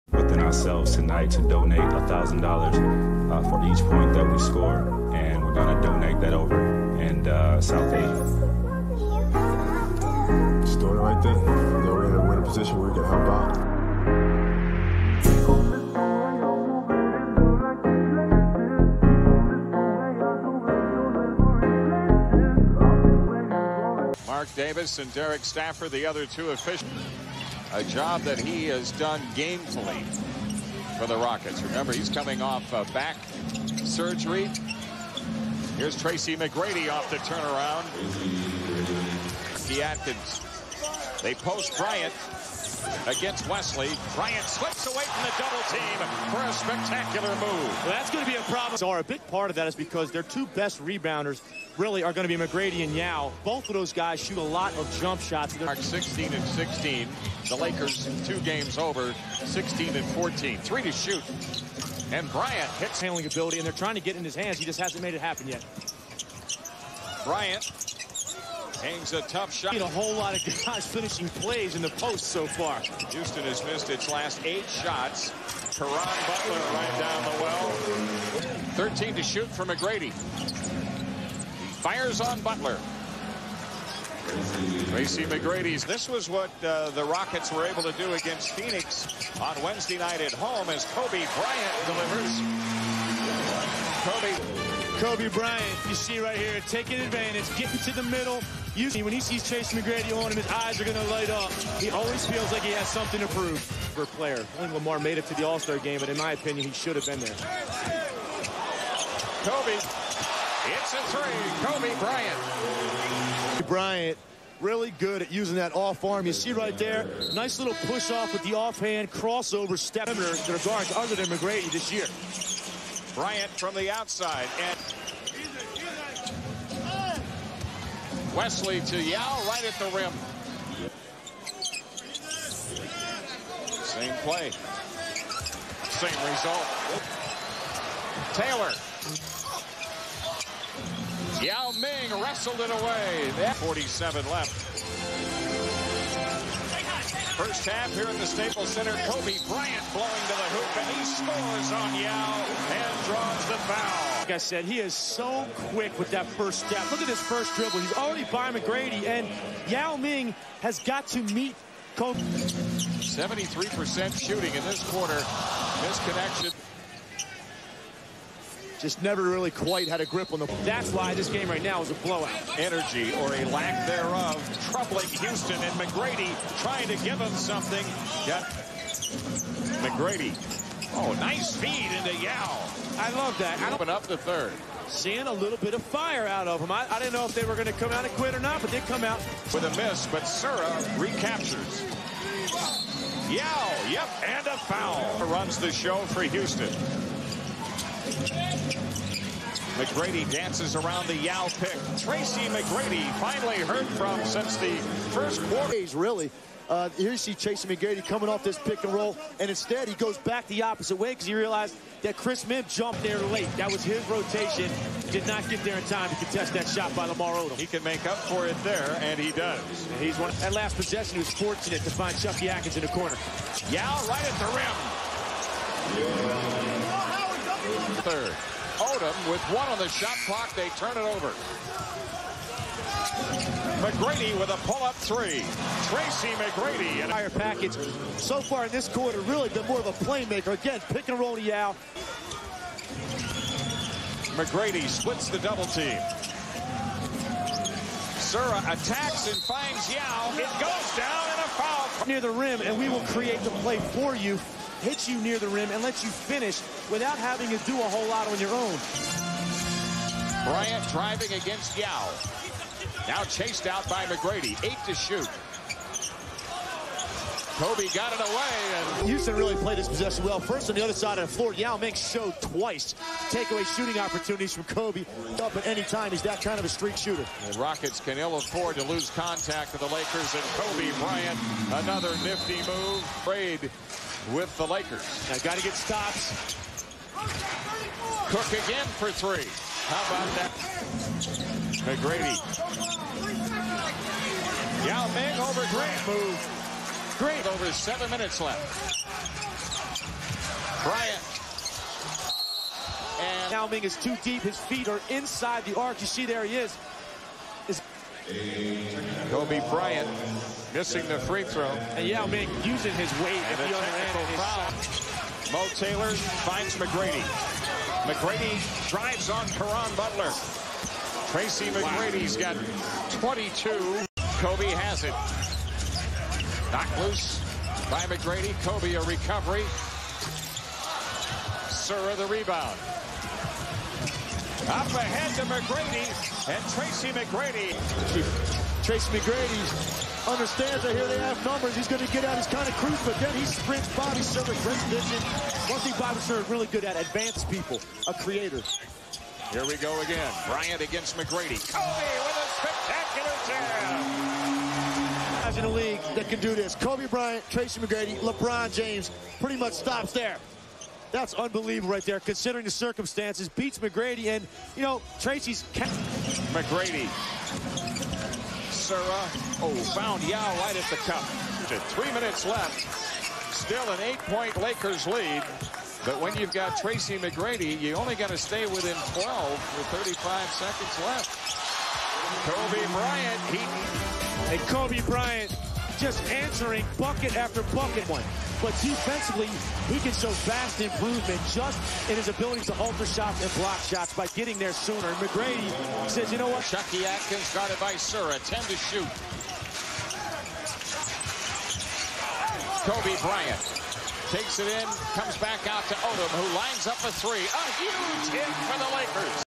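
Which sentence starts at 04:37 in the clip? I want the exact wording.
Rockets can ill afford to lose contact with the Lakers.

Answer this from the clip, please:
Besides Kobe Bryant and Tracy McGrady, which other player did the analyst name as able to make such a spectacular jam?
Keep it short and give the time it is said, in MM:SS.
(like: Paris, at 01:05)
LeBron James, at 05:58.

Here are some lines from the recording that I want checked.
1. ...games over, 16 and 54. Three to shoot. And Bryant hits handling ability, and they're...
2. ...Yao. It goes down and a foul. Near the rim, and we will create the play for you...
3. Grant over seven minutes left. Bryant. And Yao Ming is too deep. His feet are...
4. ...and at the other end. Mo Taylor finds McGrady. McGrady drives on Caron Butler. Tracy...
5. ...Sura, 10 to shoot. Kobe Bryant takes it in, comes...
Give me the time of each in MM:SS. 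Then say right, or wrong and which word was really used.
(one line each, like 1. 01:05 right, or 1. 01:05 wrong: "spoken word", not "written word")
1. 00:58 wrong: "14", not "54"
2. 04:09 right
3. 04:57 right
4. 05:13 right
5. 06:37 right.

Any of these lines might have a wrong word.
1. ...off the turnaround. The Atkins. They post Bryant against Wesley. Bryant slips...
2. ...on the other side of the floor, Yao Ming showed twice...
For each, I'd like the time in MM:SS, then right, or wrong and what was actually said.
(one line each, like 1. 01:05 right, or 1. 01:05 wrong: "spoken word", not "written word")
1. 00:36 right
2. 04:30 right.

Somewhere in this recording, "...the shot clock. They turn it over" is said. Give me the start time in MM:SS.
03:49.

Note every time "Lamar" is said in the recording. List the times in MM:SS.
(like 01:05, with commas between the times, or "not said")
01:44, 03:37.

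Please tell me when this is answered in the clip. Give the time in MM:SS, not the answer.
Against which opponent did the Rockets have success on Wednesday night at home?
01:28.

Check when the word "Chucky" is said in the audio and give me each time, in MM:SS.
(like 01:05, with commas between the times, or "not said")
03:42, 06:36.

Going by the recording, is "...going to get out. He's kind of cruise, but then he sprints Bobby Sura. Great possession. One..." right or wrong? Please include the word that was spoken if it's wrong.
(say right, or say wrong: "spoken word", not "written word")
wrong: "vision", not "possession".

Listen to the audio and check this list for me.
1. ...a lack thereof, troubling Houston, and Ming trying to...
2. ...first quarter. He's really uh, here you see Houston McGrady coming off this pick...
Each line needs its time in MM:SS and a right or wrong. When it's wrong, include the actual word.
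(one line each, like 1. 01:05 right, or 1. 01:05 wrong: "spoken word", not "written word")
1. 02:53 wrong: "McGrady", not "Ming"
2. 03:25 wrong: "Chase", not "Houston".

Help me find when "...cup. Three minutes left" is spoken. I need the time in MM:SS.
06:10.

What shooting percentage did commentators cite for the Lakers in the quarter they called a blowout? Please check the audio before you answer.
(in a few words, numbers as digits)
73%.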